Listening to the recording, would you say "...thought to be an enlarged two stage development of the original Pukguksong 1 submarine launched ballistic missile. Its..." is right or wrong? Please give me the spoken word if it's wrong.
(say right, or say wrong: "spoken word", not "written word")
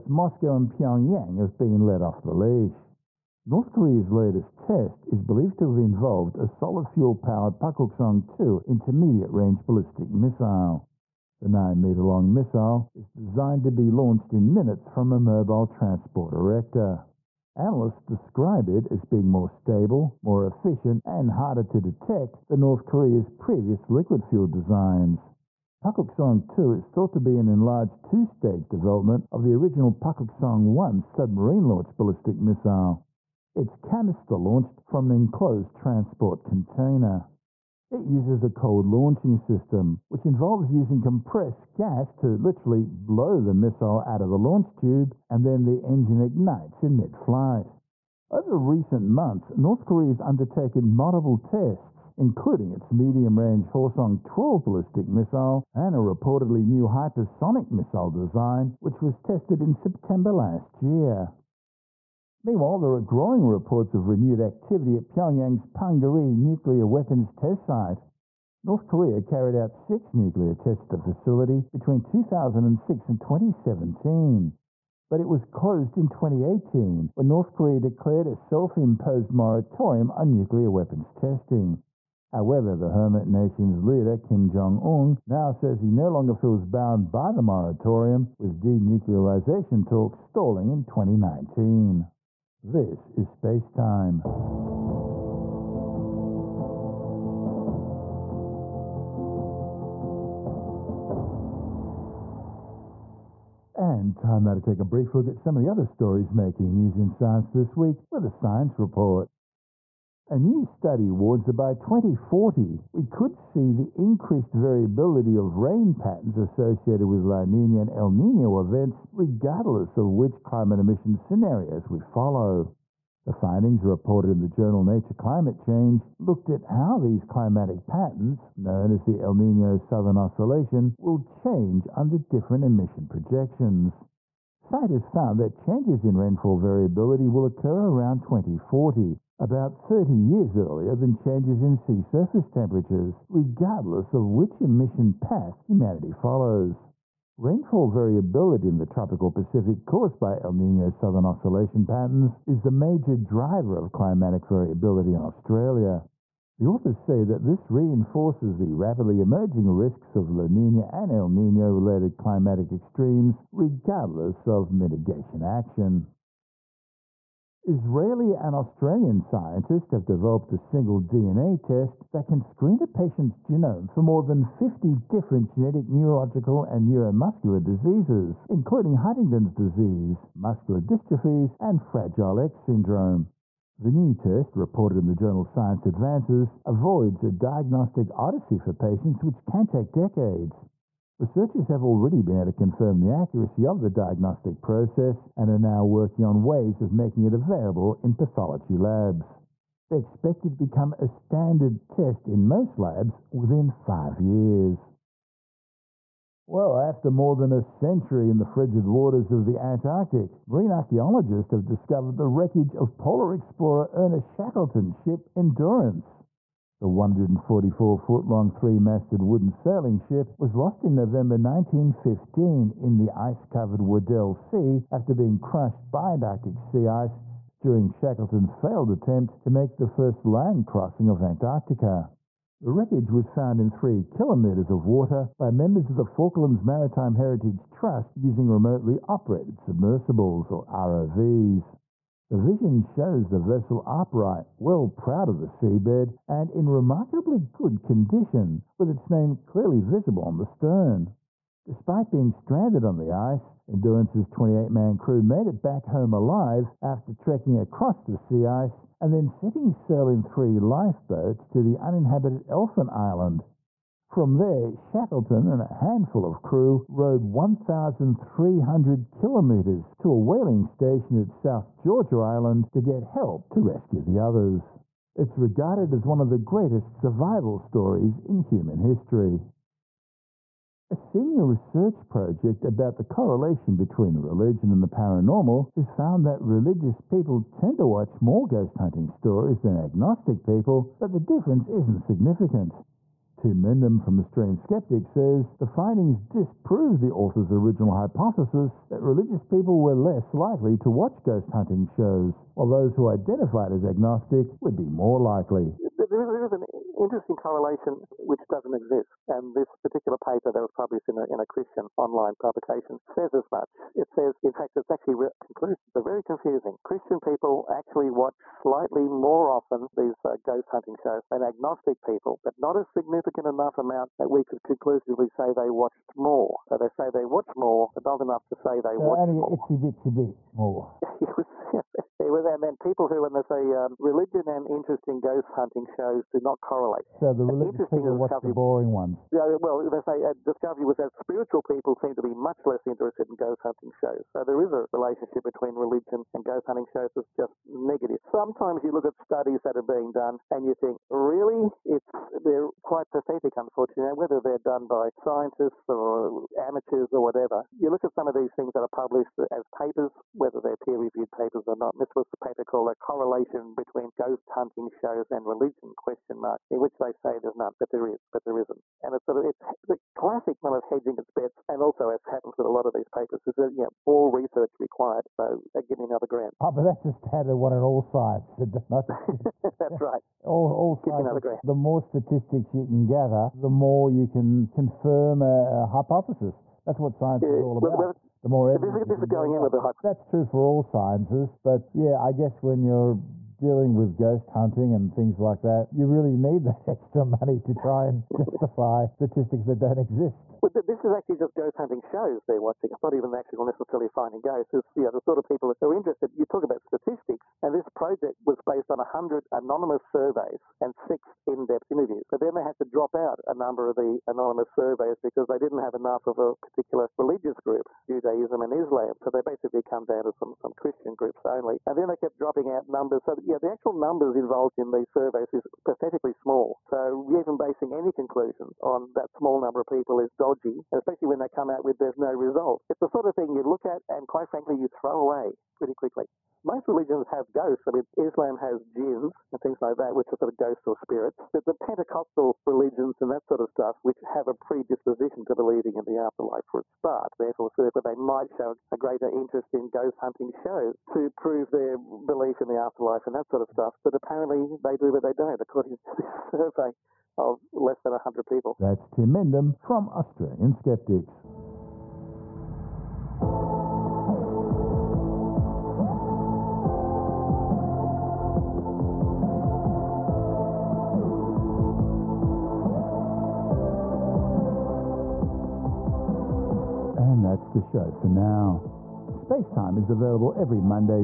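right.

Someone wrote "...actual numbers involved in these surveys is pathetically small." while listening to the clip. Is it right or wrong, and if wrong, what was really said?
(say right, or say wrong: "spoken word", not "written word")
right.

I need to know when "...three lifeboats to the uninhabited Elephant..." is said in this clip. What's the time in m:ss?
4:20.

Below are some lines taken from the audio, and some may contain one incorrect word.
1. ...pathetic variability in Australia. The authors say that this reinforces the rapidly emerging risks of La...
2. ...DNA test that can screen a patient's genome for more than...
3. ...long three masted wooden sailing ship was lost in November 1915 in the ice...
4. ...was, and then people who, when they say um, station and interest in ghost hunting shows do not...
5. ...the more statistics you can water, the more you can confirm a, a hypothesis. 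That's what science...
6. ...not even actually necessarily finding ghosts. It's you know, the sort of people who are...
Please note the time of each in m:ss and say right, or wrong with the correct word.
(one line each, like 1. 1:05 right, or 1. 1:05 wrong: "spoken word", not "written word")
1. 2:33 wrong: "climatic", not "pathetic"
2. 2:51 right
3. 3:38 right
4. 5:32 wrong: "religion", not "station"
5. 6:21 wrong: "gather", not "water"
6. 6:43 right.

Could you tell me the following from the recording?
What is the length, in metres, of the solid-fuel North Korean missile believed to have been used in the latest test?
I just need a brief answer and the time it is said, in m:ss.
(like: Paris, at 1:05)
9, at 0:11.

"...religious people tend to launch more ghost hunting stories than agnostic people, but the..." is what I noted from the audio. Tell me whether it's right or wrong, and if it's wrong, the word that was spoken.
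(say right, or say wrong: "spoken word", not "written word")
wrong: "watch", not "launch".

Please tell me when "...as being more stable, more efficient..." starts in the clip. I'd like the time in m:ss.
0:18.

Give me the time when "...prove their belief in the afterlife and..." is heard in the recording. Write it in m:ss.
7:31.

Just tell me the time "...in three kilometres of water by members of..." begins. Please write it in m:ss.
3:53.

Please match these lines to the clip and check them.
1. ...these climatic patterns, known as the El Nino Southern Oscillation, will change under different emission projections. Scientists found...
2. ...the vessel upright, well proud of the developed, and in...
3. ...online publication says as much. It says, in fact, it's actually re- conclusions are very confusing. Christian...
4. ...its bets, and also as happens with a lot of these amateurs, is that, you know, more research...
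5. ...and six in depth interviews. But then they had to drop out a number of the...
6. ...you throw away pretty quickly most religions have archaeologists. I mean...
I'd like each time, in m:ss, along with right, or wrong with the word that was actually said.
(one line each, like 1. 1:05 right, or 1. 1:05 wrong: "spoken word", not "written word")
1. 2:06 right
2. 4:03 wrong: "seabed", not "developed"
3. 5:11 right
4. 6:11 wrong: "papers", not "amateurs"
5. 6:50 right
6. 7:14 wrong: "ghosts", not "archaeologists".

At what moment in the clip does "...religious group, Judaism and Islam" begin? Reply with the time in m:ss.
6:57.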